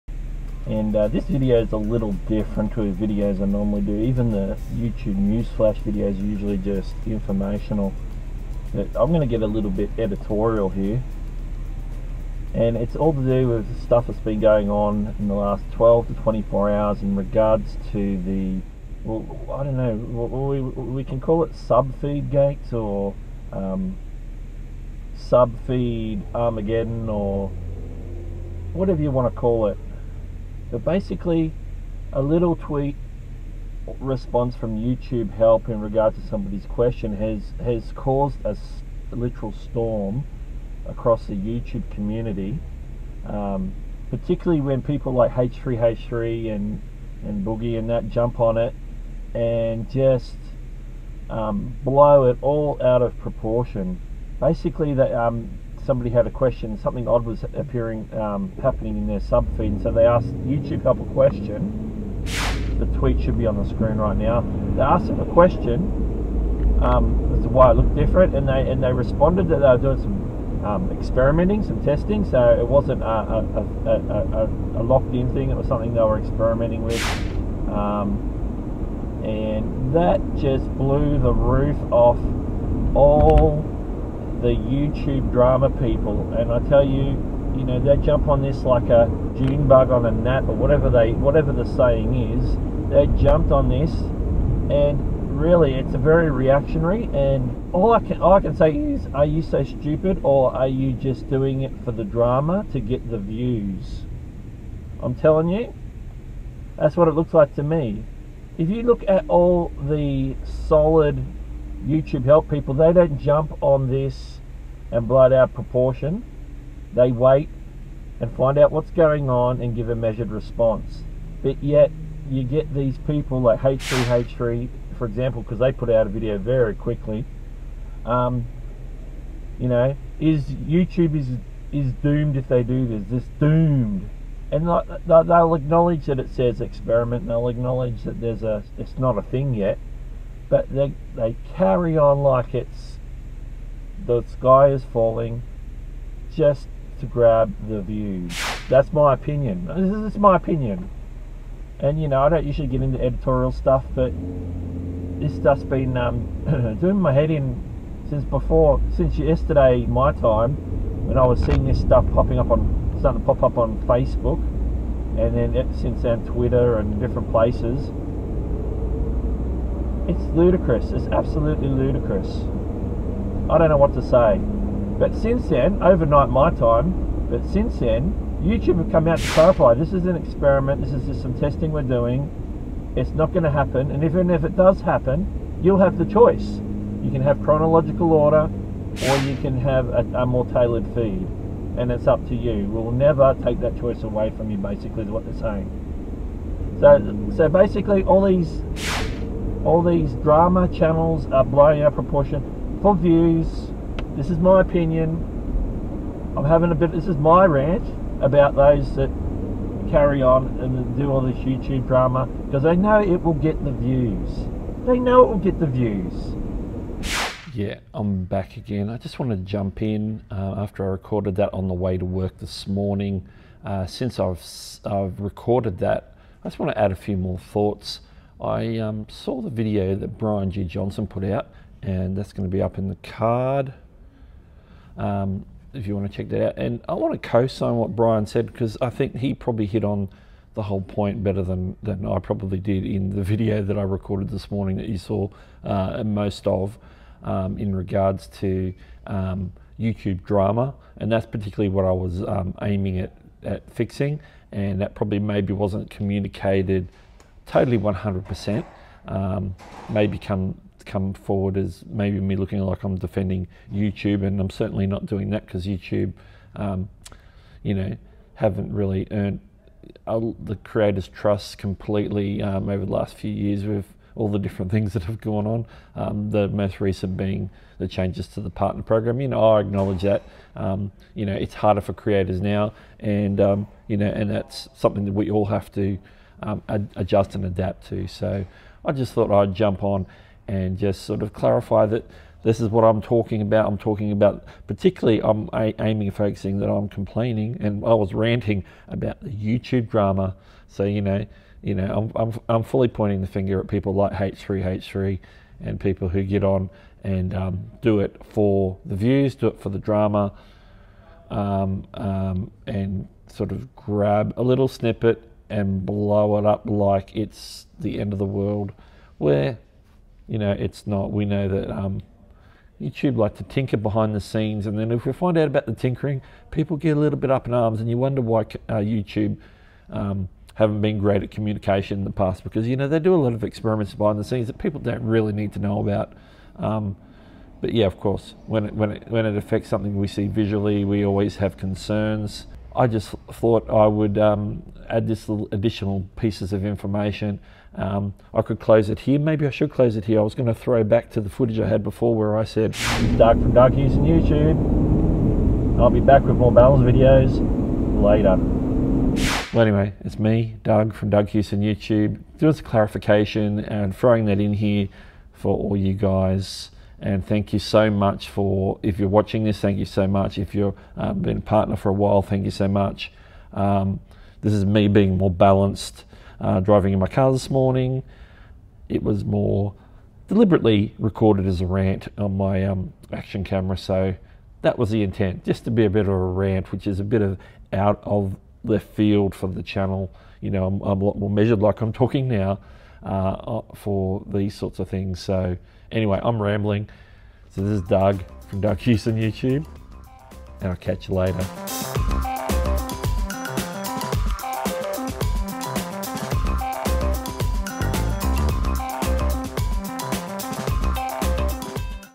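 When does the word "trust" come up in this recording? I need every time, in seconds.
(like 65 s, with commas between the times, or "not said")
271 s.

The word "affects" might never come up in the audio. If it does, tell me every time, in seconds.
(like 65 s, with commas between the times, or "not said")
339 s.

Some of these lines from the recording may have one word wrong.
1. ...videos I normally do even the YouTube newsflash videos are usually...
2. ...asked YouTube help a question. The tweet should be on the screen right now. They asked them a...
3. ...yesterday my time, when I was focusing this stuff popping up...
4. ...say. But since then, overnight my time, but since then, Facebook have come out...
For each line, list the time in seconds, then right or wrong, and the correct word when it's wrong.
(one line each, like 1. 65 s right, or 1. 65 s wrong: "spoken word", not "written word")
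1. 3 s right
2. 60 s right
3. 159 s wrong: "seeing", not "focusing"
4. 174 s wrong: "YouTube", not "Facebook".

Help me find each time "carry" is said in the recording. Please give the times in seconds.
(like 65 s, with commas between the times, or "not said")
141 s, 209 s.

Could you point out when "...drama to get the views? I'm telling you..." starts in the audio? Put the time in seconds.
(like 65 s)
102 s.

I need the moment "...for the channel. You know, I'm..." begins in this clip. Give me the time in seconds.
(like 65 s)
389 s.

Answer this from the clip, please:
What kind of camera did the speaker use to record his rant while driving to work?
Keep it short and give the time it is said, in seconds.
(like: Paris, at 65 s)
action camera, at 383 s.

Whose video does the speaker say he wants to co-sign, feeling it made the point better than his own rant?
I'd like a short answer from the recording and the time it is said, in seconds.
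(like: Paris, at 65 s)
Brian G. Johnson, at 230 s.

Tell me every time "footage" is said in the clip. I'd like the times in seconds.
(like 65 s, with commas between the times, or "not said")
351 s.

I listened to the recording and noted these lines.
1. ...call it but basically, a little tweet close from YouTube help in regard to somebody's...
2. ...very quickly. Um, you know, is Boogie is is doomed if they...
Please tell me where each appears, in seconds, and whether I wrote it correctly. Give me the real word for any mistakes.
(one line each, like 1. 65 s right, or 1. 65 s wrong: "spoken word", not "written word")
1. 29 s wrong: "response", not "close"
2. 126 s wrong: "YouTube", not "Boogie".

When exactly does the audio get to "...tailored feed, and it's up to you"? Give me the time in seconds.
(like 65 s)
190 s.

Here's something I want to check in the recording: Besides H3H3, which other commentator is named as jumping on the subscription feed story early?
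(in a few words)
Boogie.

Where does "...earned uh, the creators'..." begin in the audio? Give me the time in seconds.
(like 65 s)
269 s.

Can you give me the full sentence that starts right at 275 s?
Um, the most recent being the changes to the partner program.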